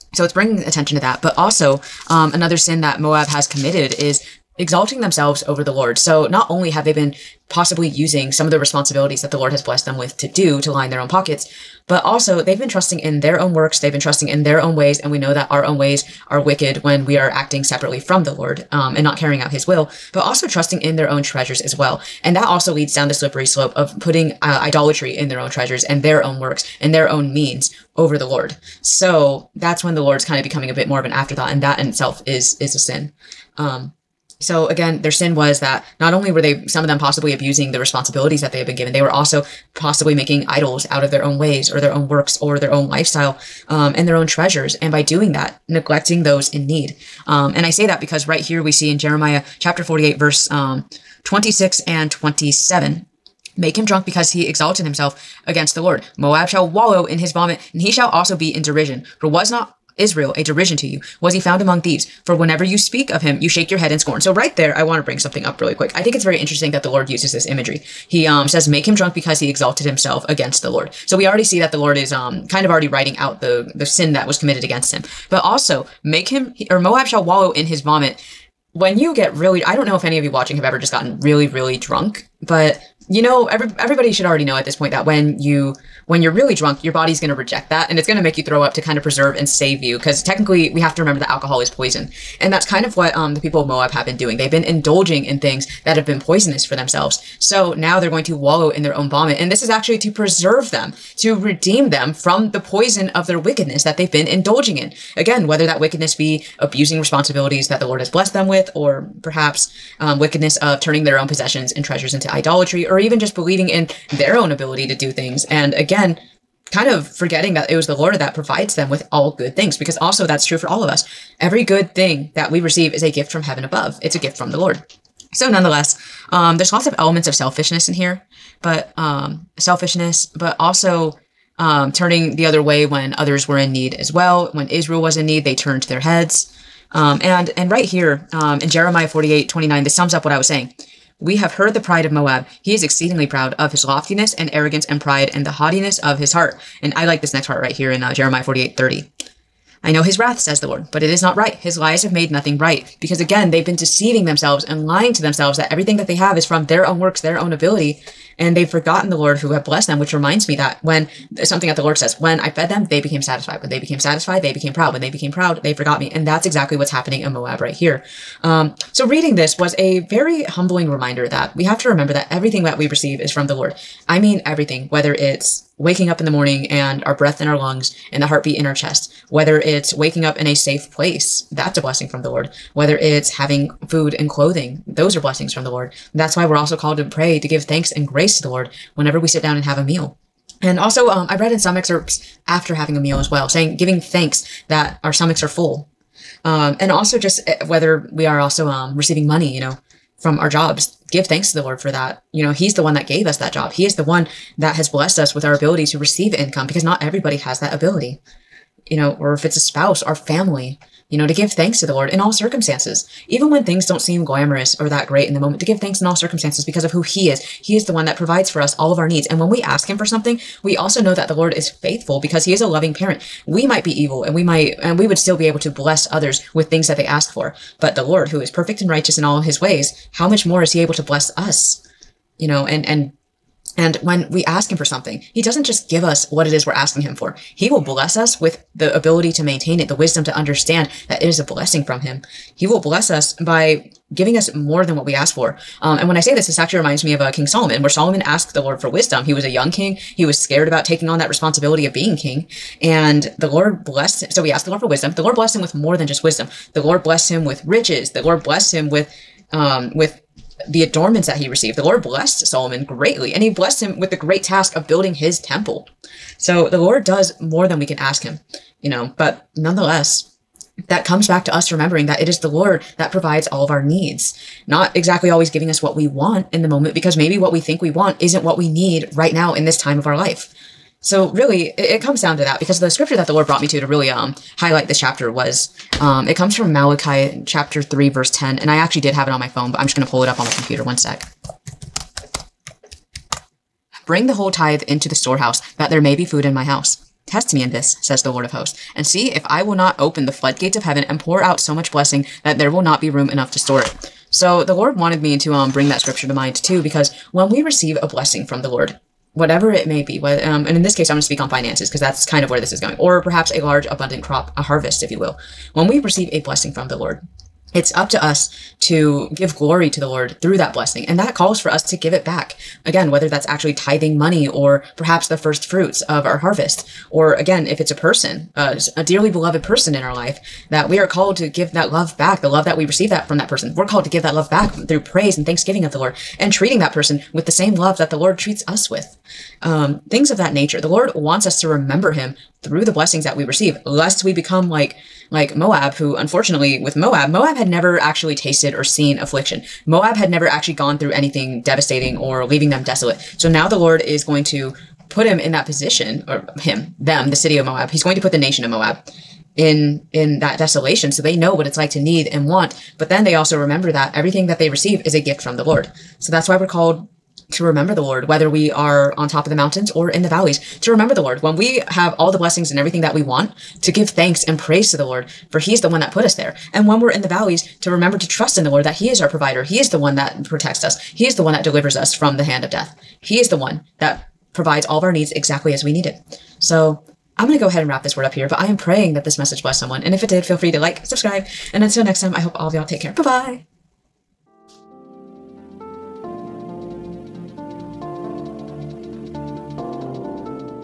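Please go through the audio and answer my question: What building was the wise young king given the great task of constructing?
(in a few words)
His temple.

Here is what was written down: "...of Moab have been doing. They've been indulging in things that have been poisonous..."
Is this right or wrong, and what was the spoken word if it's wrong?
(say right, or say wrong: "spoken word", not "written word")
right.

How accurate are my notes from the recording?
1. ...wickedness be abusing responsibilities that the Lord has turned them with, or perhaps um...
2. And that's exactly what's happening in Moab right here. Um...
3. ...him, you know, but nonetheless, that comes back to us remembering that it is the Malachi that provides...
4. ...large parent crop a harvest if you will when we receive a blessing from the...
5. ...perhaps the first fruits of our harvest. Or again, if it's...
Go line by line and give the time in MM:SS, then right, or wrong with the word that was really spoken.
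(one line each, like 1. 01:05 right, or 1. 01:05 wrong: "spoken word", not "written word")
1. 01:45 wrong: "blessed", not "turned"
2. 02:46 right
3. 04:28 wrong: "Lord", not "Malachi"
4. 05:13 wrong: "abundant", not "parent"
5. 05:24 right.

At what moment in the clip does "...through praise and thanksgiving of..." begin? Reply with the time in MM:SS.
05:34.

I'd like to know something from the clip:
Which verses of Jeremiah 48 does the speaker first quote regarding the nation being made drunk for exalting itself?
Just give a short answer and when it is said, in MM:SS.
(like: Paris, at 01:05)
26 and 27, at 00:51.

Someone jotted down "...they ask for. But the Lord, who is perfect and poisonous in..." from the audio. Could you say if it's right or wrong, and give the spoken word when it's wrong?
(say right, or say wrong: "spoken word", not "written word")
wrong: "righteous", not "poisonous".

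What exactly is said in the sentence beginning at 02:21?
We have heard the pride of Moab.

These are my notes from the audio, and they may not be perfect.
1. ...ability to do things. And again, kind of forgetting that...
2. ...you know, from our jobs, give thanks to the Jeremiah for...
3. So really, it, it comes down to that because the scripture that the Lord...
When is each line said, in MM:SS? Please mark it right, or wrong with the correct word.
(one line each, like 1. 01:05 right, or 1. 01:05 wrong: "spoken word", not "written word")
1. 01:54 right
2. 03:19 wrong: "Lord", not "Jeremiah"
3. 04:40 right.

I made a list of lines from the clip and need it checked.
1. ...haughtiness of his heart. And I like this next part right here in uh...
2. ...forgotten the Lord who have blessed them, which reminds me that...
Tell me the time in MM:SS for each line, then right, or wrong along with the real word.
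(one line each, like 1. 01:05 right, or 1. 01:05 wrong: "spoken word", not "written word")
1. 02:25 right
2. 02:38 right.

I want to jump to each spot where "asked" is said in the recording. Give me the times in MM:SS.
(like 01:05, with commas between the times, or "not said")
04:08, 04:14.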